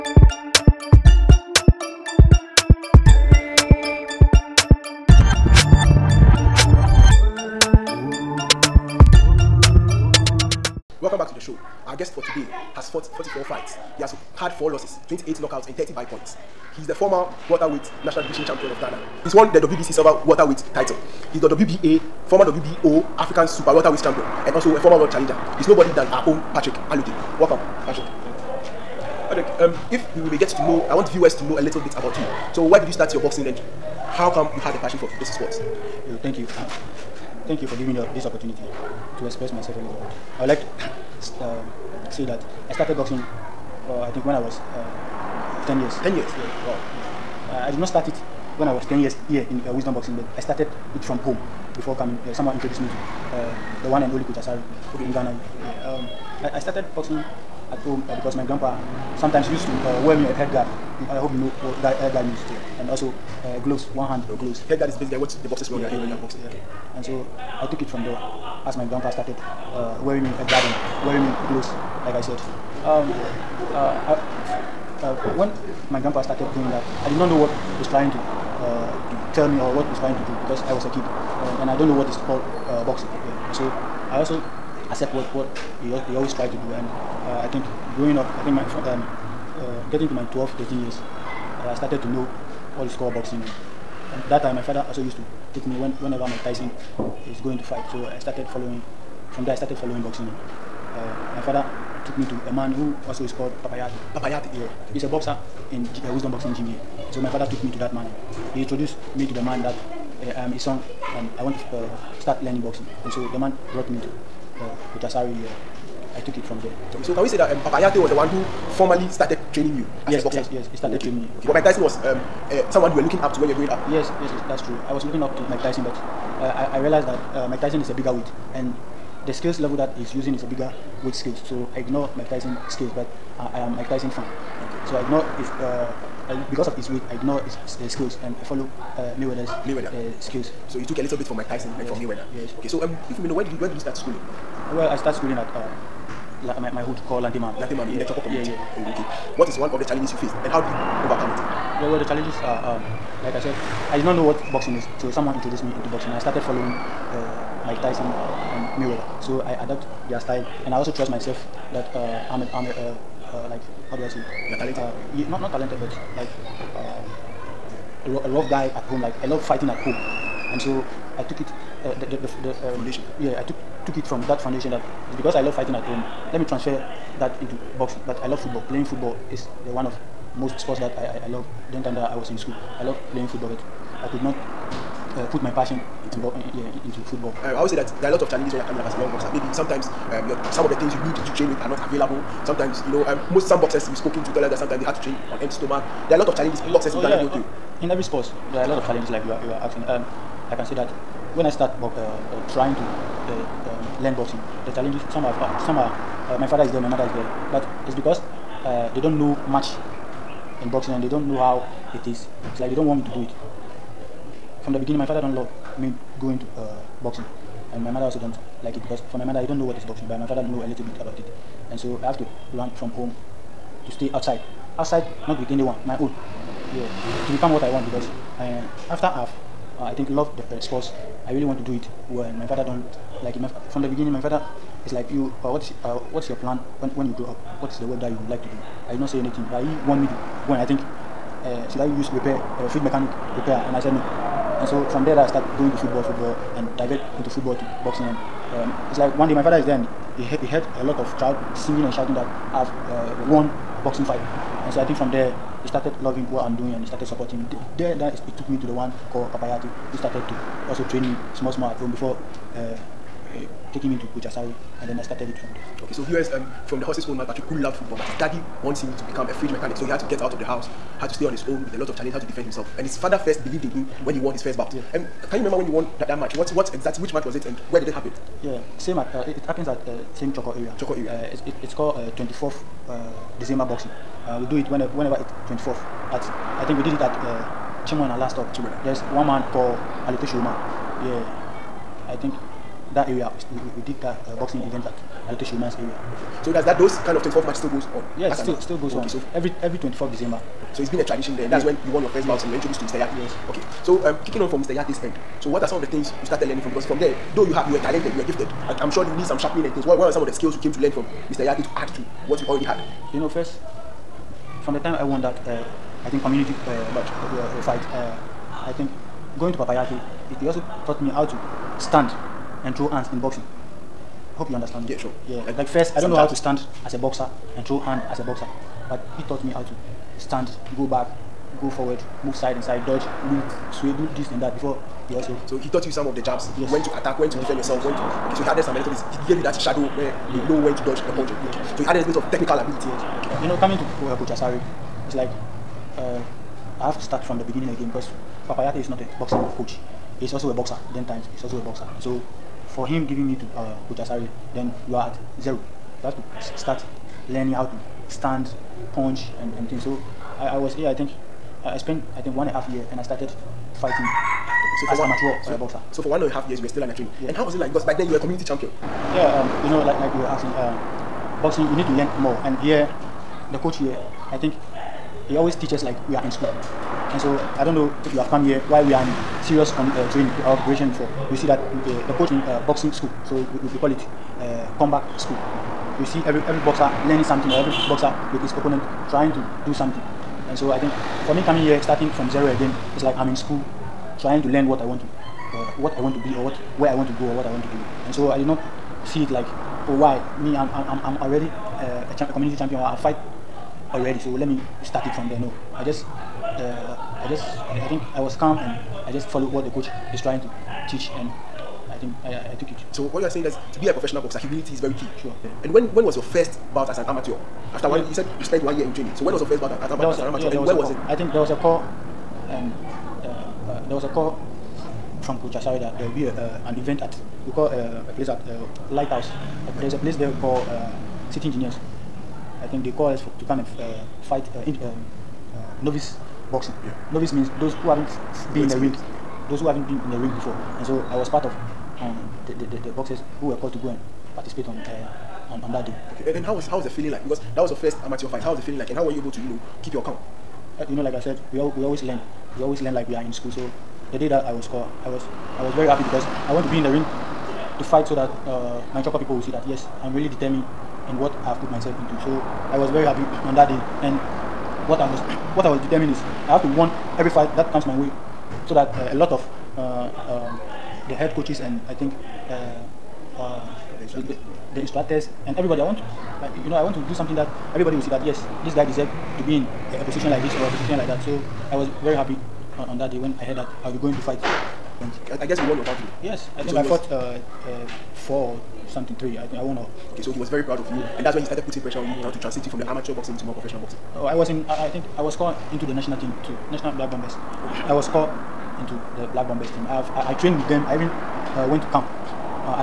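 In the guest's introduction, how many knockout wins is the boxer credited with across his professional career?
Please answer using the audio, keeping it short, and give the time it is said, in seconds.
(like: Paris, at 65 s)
28, at 15 s.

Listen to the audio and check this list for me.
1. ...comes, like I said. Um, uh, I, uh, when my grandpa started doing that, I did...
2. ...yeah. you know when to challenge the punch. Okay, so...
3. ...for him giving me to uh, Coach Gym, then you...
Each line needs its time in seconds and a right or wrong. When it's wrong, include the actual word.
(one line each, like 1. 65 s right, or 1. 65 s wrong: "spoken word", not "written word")
1. 71 s wrong: "gloves", not "comes"
2. 340 s wrong: "dodge", not "challenge"
3. 352 s wrong: "Asari", not "Gym".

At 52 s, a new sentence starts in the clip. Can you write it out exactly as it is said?
Uh, someone introduced me to the one and only Coach Asari in Ghana.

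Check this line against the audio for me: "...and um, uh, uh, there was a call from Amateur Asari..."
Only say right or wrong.
wrong.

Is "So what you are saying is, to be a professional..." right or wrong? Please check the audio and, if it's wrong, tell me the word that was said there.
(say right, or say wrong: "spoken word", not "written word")
right.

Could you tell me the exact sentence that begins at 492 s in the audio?
to transition you from the amateur boxing to more professional boxing.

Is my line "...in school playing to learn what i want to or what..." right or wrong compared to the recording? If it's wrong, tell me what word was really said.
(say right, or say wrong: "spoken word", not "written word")
wrong: "trying", not "playing".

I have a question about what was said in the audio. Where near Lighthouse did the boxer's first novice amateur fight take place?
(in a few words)
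City Engineers.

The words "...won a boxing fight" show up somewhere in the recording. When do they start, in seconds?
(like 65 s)
253 s.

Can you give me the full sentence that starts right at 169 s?
Like I love fighting at home, and so I took it.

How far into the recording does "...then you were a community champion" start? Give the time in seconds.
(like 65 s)
367 s.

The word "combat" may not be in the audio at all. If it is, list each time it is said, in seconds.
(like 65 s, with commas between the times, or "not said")
384 s.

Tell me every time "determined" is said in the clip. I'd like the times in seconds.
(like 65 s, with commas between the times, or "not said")
460 s, 465 s.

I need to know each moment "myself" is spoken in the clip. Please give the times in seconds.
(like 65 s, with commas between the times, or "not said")
39 s, 161 s, 461 s.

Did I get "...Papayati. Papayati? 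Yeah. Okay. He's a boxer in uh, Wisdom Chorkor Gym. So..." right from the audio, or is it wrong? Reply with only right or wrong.
wrong.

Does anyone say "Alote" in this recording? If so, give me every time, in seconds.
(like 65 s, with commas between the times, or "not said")
290 s, 295 s.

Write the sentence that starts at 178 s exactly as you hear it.
Playing football is one of most sports that I, I, I love during time that I was in school.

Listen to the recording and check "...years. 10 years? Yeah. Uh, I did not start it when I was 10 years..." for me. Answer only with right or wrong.
right.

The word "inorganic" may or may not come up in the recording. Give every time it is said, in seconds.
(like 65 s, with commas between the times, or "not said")
not said.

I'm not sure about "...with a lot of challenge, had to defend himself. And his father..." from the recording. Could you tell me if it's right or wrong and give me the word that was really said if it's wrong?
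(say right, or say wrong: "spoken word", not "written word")
right.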